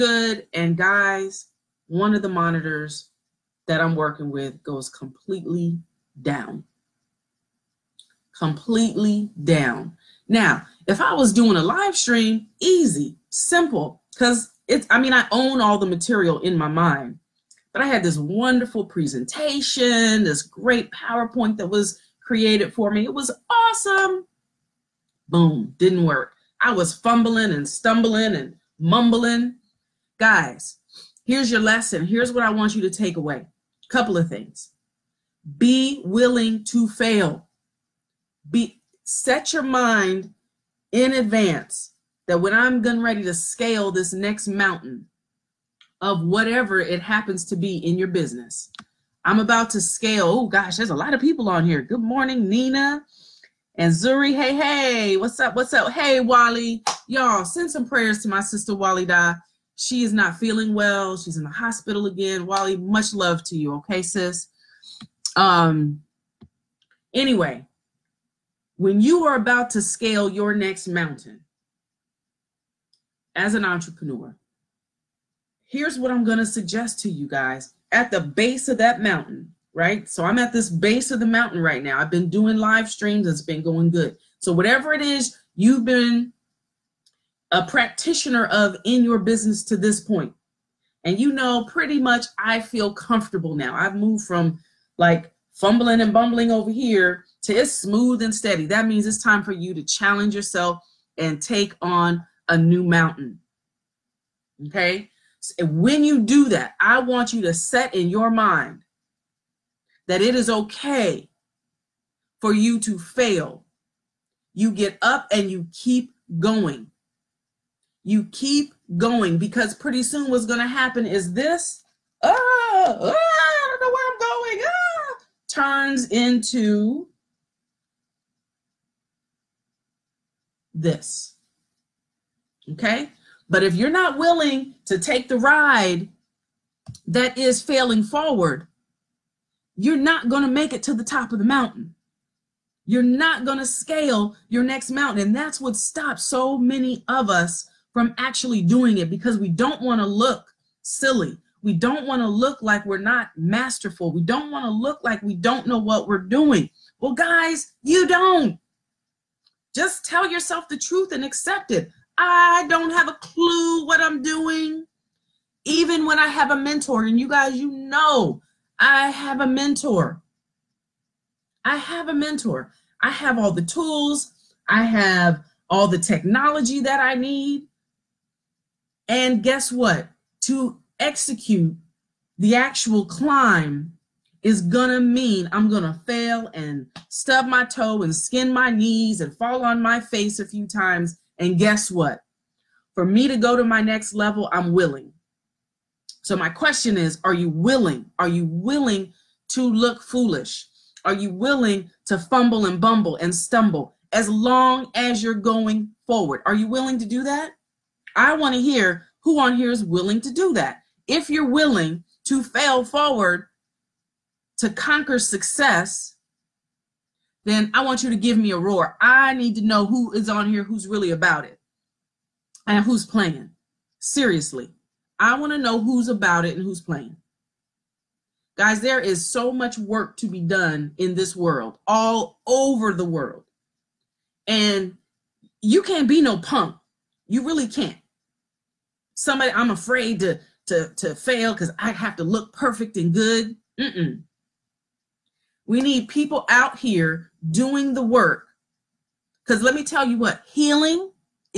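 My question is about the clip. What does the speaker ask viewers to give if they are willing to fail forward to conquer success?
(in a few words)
A roar.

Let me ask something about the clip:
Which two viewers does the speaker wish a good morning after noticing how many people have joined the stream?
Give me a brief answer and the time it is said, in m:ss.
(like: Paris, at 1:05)
Nina and Zuri, at 0:52.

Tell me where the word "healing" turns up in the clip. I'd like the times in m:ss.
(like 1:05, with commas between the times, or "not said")
4:10.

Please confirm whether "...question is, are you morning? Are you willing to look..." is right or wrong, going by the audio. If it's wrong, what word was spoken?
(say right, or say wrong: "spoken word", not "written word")
wrong: "willing", not "morning".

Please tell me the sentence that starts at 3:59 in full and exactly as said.
Somebody, I'm afraid to to to fail because I have to look perfect and good.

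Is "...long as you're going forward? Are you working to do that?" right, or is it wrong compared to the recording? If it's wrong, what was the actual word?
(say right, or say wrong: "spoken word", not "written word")
wrong: "willing", not "working".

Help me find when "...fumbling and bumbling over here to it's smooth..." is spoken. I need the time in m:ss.
1:35.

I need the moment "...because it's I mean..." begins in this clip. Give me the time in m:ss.
0:14.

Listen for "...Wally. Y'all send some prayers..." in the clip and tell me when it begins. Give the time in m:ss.
0:56.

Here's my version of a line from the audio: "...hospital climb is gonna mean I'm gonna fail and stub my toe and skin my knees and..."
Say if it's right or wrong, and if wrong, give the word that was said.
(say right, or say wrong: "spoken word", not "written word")
wrong: "actual", not "hospital".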